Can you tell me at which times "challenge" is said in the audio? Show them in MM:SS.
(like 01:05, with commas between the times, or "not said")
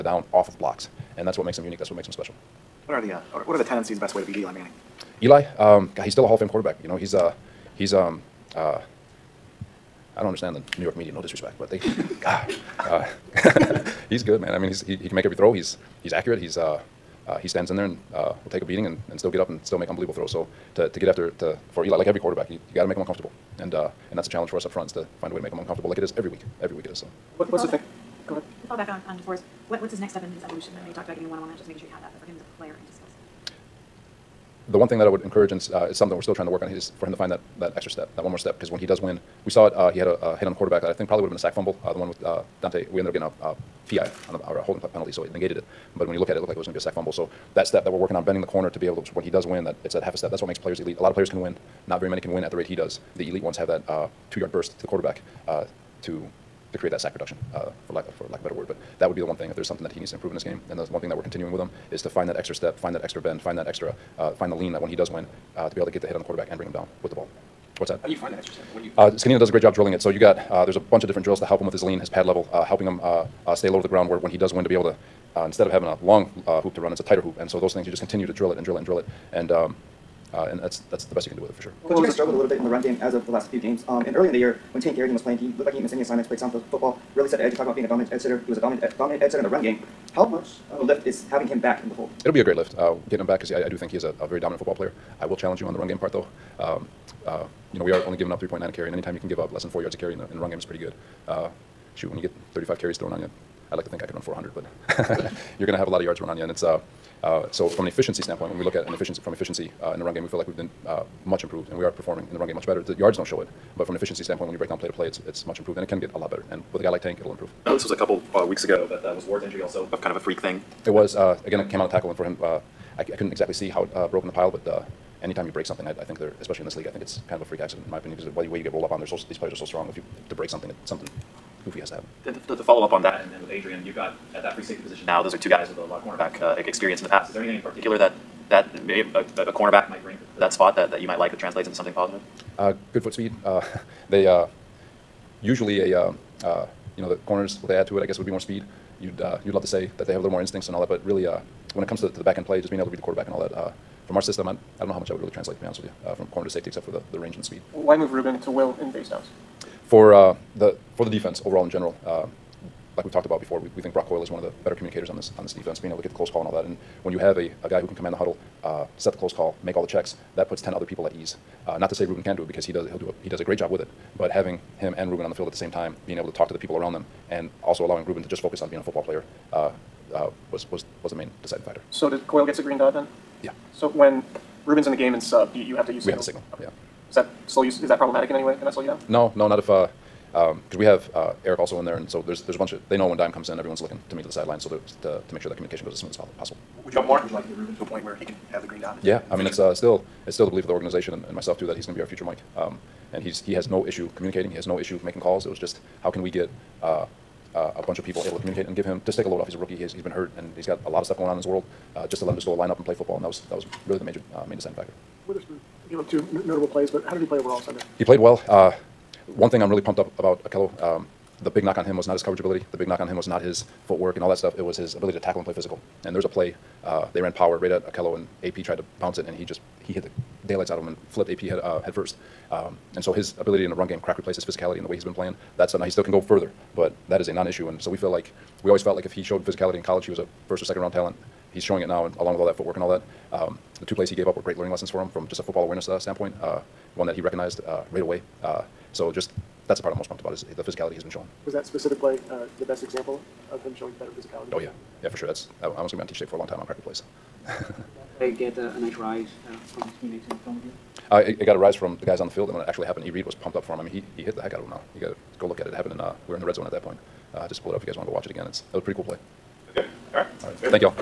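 00:24, 01:35.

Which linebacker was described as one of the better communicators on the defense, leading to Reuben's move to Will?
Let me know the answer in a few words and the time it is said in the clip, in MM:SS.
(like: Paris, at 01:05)
Brock Coyle, at 02:43.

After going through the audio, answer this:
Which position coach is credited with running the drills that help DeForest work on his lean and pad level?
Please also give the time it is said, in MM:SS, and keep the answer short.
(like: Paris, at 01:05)
Zgonina, at 01:09.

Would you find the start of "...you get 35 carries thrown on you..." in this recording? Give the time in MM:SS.
01:42.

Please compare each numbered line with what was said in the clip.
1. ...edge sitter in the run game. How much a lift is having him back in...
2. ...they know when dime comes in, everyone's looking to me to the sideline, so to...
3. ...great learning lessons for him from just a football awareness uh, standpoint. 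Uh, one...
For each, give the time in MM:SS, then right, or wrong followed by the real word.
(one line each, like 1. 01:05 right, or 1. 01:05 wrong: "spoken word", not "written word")
1. 01:29 right
2. 03:12 right
3. 04:04 right.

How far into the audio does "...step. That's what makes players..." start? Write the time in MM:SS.
00:50.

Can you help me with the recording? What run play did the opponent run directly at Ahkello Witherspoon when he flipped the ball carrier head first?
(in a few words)
power.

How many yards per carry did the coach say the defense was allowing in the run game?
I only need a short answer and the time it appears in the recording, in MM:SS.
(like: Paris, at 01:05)
3.9, at 01:38.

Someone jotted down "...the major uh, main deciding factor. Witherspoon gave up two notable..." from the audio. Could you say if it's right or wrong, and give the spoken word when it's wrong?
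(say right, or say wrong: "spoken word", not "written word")
right.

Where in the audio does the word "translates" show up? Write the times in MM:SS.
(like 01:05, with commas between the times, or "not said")
02:21, 02:35.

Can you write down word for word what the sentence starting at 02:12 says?
And to, to, to follow up on that, and, and with Adrian, you've got at that free safety position now.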